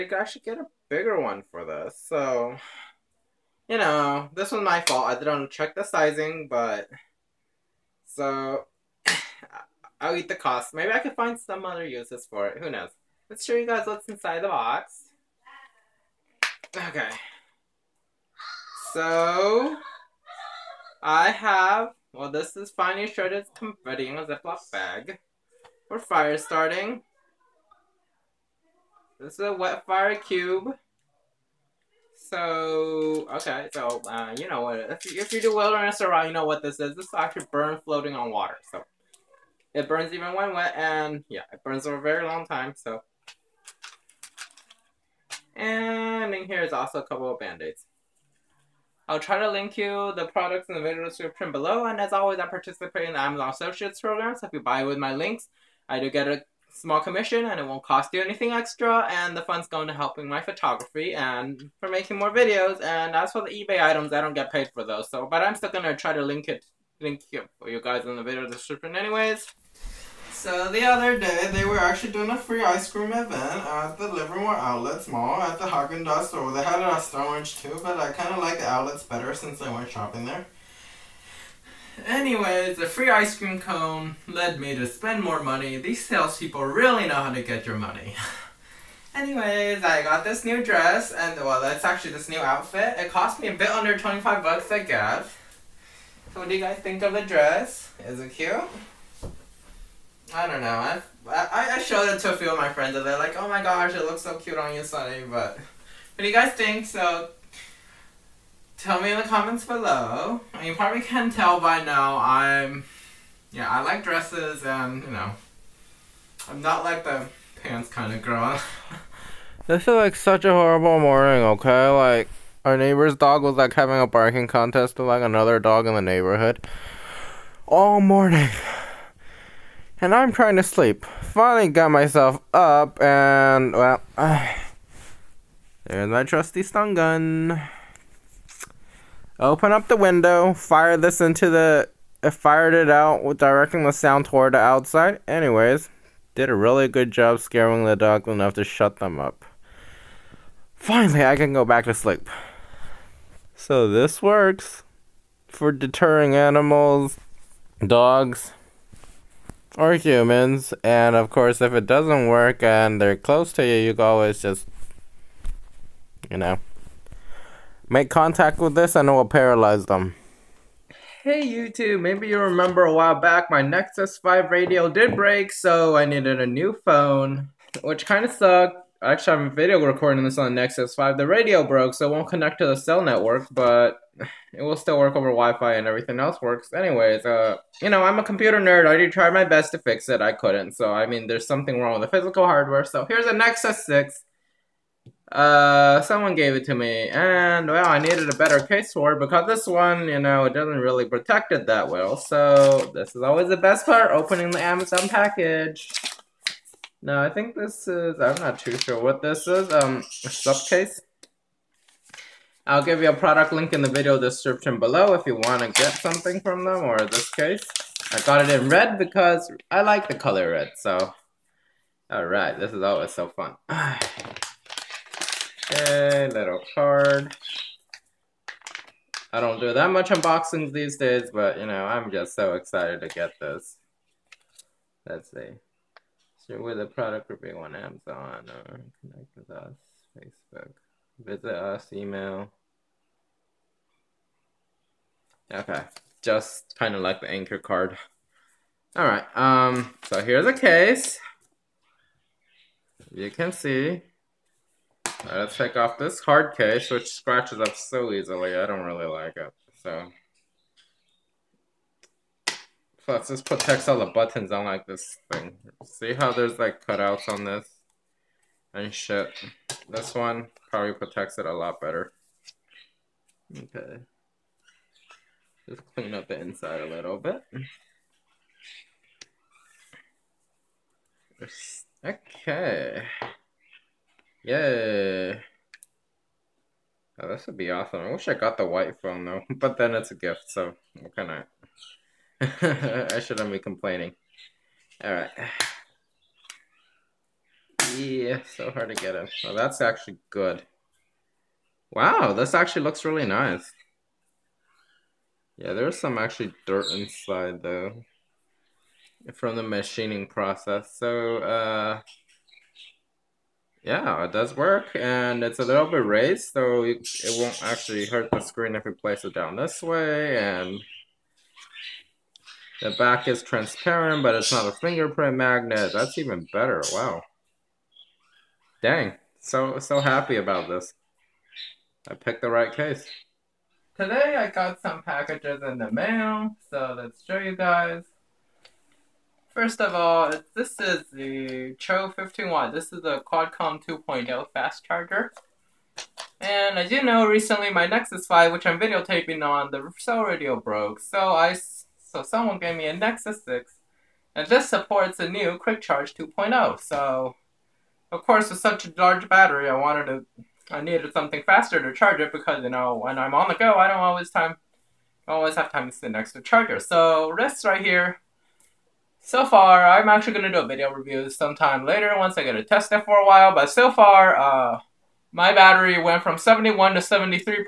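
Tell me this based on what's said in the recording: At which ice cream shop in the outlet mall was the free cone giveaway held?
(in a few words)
Haagen-Dazs.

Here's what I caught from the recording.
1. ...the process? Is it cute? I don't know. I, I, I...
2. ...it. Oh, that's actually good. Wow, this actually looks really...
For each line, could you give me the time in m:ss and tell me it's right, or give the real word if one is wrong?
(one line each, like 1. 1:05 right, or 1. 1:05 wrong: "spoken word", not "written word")
1. 1:37 wrong: "dress", not "process"
2. 4:59 right.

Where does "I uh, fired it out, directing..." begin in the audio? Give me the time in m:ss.
2:22.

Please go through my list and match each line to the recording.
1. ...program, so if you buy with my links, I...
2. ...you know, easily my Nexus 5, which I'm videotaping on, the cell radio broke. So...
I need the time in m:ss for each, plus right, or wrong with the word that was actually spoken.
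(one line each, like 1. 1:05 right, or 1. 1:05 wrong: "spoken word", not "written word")
1. 0:54 right
2. 5:46 wrong: "recently", not "easily".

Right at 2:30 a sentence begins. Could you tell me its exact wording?
Finally, I can go back to sleep.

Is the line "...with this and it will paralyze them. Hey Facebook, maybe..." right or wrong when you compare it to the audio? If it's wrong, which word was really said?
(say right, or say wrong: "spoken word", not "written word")
wrong: "YouTube", not "Facebook".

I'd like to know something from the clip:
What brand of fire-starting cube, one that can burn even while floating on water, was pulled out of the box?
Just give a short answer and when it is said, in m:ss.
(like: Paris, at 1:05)
WetFire, at 0:29.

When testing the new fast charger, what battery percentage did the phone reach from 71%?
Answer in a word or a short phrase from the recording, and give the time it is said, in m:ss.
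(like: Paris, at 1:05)
73%, at 6:16.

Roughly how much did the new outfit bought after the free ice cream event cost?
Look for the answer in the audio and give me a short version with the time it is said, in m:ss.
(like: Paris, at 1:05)
under $25, at 1:33.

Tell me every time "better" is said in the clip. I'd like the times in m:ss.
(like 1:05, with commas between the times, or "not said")
1:19, 3:18, 4:31, 5:26.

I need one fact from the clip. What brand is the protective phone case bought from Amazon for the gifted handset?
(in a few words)
Supcase.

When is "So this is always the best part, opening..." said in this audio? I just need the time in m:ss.
3:22.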